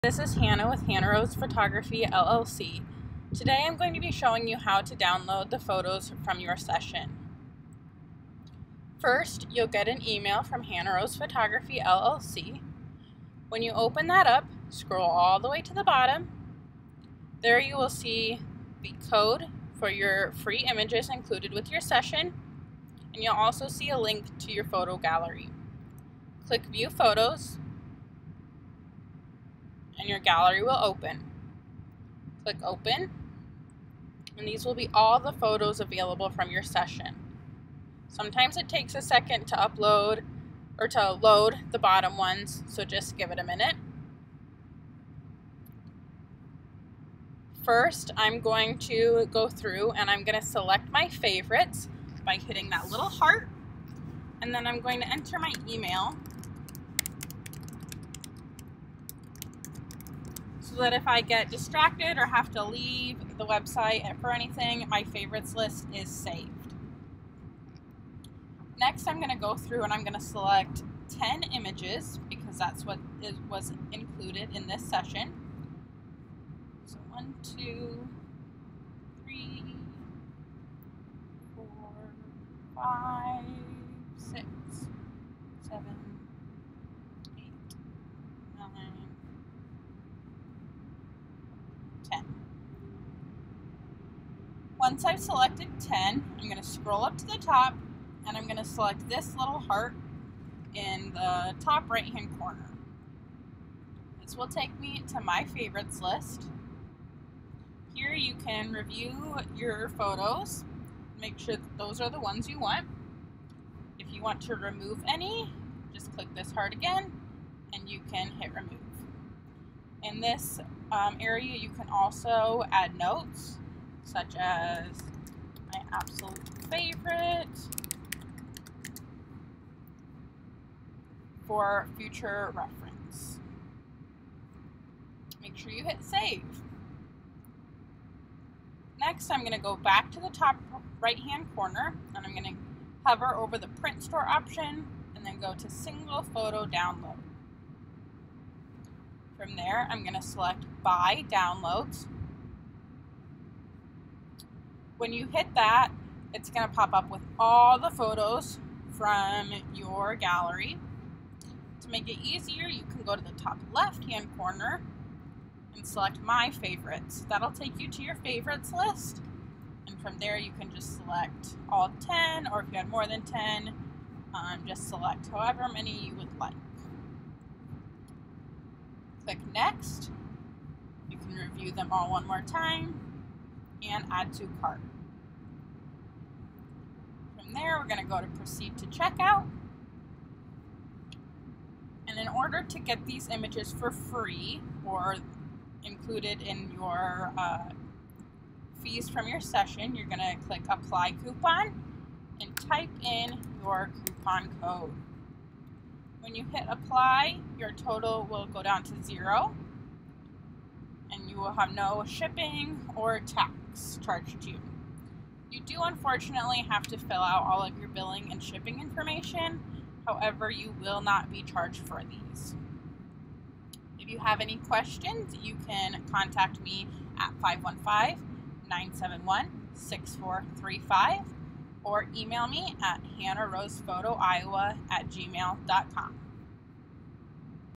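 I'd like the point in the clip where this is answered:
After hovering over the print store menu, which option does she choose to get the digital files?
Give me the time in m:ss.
2:25.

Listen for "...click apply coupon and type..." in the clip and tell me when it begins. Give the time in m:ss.
3:20.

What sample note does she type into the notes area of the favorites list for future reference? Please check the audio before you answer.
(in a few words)
my absolute favorite.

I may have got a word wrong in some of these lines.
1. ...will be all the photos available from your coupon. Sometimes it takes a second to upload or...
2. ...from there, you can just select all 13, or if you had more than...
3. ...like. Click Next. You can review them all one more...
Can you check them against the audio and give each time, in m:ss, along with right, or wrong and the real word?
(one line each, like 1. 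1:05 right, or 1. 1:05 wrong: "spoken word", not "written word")
1. 0:34 wrong: "session", not "coupon"
2. 2:50 wrong: "10", not "13"
3. 2:56 right.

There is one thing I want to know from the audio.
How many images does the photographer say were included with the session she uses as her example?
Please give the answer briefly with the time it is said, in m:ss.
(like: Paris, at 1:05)
10, at 1:11.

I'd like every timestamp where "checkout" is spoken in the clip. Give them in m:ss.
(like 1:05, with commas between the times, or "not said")
3:08.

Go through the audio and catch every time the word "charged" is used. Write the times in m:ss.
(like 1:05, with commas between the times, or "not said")
3:34, 3:41.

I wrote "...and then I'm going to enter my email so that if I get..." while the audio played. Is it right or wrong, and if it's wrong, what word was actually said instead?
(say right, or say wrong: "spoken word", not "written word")
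right.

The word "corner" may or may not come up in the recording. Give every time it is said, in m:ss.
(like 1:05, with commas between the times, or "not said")
1:42, 2:21, 2:44.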